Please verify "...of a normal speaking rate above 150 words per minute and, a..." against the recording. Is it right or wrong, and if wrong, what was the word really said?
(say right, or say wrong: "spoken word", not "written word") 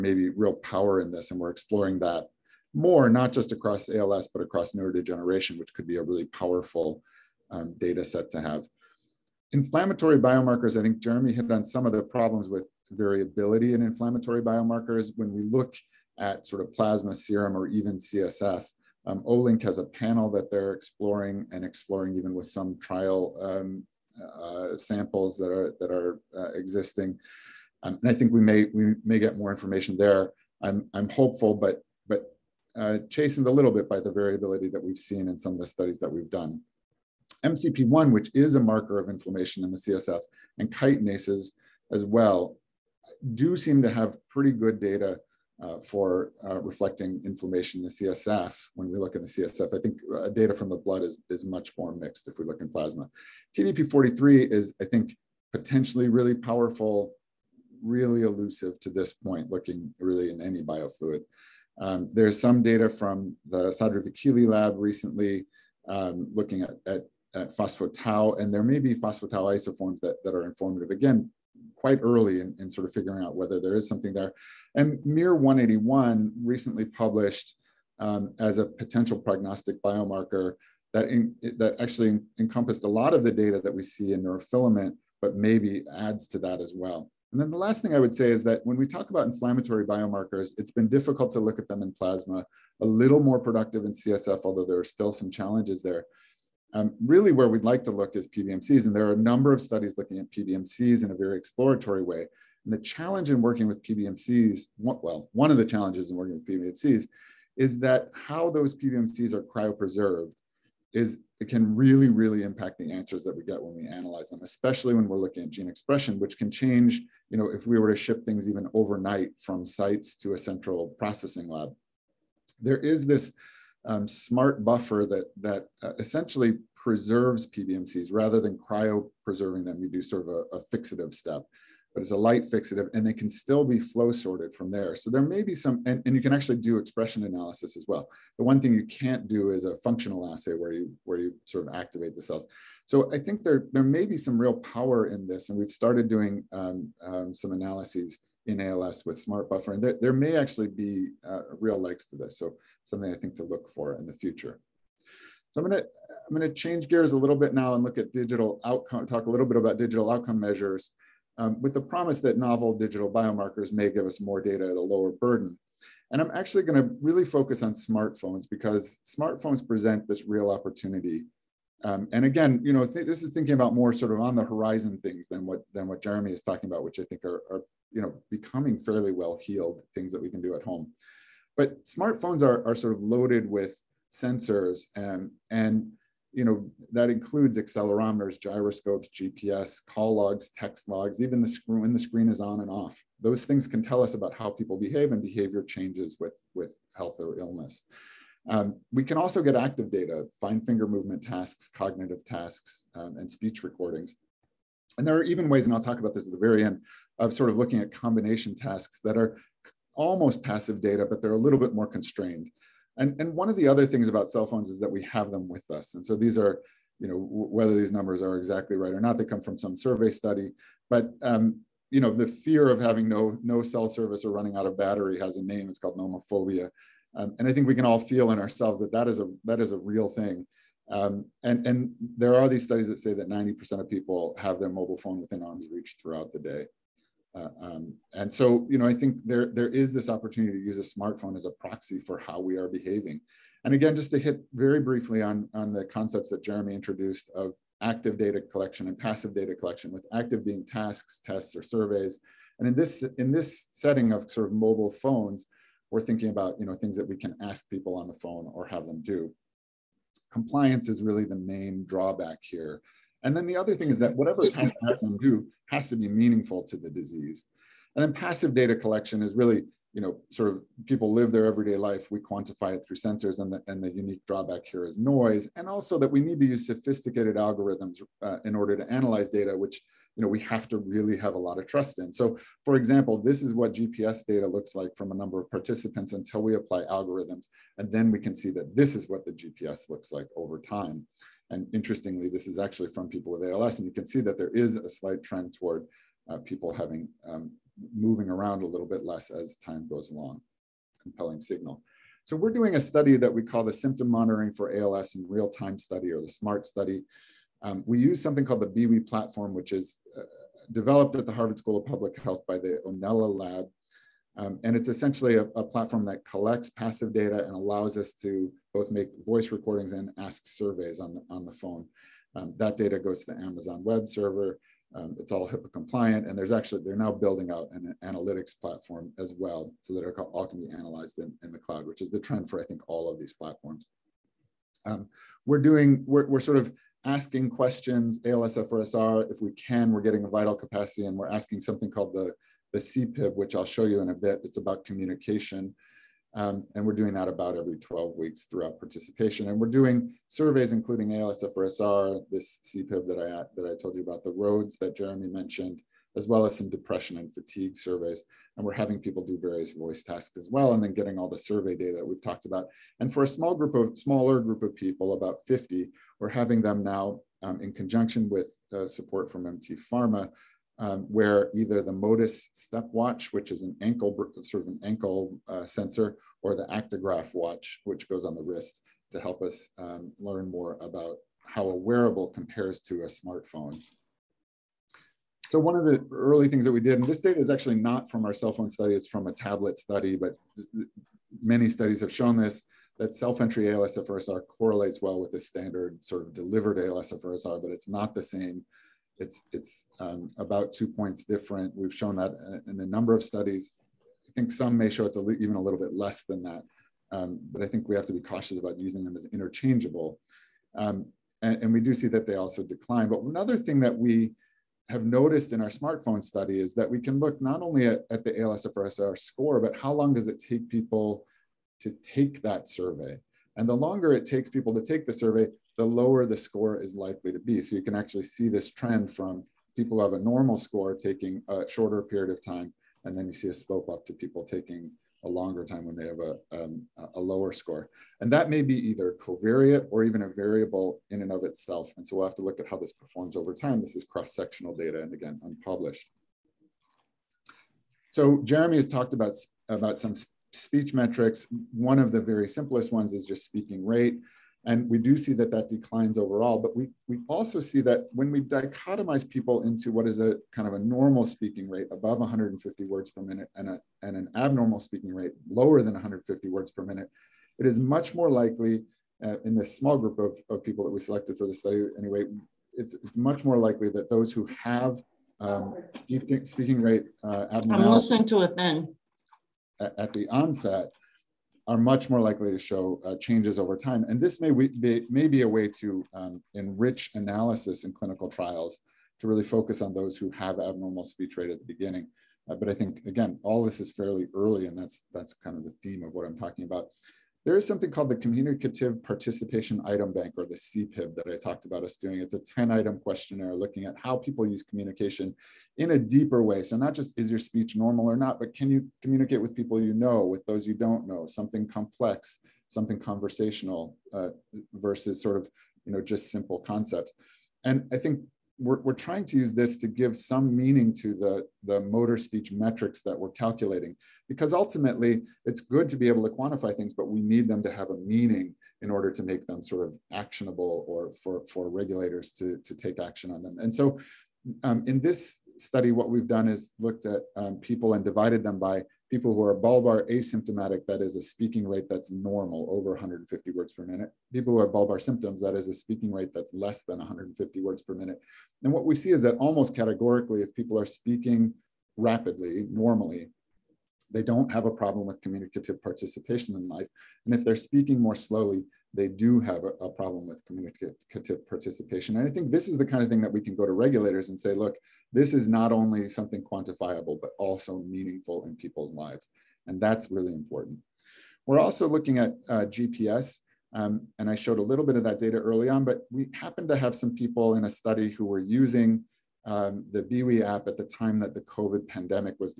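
right.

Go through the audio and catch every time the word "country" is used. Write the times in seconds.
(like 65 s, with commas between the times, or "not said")
not said.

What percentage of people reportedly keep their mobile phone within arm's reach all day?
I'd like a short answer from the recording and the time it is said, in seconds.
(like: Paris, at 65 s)
90%, at 233 s.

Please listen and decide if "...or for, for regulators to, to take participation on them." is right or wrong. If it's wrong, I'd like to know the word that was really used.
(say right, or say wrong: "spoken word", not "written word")
wrong: "action", not "participation".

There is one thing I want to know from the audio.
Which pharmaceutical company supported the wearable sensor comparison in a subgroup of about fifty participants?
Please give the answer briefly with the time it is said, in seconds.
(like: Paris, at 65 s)
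MT Pharma, at 369 s.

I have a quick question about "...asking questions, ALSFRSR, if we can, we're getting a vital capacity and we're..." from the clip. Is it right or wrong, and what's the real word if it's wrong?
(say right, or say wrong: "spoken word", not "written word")
right.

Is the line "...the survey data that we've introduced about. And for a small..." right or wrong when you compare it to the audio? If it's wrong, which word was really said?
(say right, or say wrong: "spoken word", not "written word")
wrong: "talked", not "introduced".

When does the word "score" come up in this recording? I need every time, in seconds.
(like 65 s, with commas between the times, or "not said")
419 s, 426 s, 430 s, 437 s.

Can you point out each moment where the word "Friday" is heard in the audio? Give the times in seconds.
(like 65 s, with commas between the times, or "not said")
not said.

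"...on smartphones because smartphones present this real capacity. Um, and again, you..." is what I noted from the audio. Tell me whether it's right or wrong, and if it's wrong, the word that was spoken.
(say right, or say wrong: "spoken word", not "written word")
wrong: "opportunity", not "capacity".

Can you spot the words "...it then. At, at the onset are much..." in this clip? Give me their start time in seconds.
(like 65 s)
478 s.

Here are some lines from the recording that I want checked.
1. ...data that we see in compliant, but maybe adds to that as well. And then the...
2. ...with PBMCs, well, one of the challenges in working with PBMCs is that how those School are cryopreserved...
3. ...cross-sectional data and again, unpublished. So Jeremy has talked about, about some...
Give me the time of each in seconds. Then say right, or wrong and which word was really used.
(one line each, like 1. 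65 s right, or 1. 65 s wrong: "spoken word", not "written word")
1. 83 s wrong: "neurofilament", not "compliant"
2. 103 s wrong: "PBMCs", not "School"
3. 444 s right.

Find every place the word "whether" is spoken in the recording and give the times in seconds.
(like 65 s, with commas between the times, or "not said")
73 s, 217 s.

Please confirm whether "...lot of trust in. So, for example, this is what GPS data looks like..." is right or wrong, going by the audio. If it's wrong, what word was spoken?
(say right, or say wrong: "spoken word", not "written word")
right.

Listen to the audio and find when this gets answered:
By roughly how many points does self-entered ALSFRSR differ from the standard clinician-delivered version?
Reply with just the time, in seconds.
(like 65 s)
400 s.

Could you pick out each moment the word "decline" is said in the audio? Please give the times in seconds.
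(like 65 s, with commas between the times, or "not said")
412 s, 455 s.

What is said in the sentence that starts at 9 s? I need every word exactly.
Inflammatory biomarkers, I think Jeremy hit on some of the problems with variability in inflammatory biomarkers.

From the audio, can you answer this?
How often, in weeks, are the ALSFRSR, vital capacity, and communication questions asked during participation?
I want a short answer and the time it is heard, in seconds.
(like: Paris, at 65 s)
12 weeks, at 347 s.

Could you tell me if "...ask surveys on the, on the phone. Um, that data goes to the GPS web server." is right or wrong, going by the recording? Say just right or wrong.
wrong.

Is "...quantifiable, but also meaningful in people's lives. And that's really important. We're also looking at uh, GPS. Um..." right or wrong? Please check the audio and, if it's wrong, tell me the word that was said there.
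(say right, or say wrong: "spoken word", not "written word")
right.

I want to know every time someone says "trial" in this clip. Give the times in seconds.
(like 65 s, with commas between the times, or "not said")
22 s, 488 s.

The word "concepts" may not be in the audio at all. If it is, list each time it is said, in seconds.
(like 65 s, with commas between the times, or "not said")
245 s, 516 s.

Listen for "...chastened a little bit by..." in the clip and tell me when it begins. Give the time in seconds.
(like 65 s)
33 s.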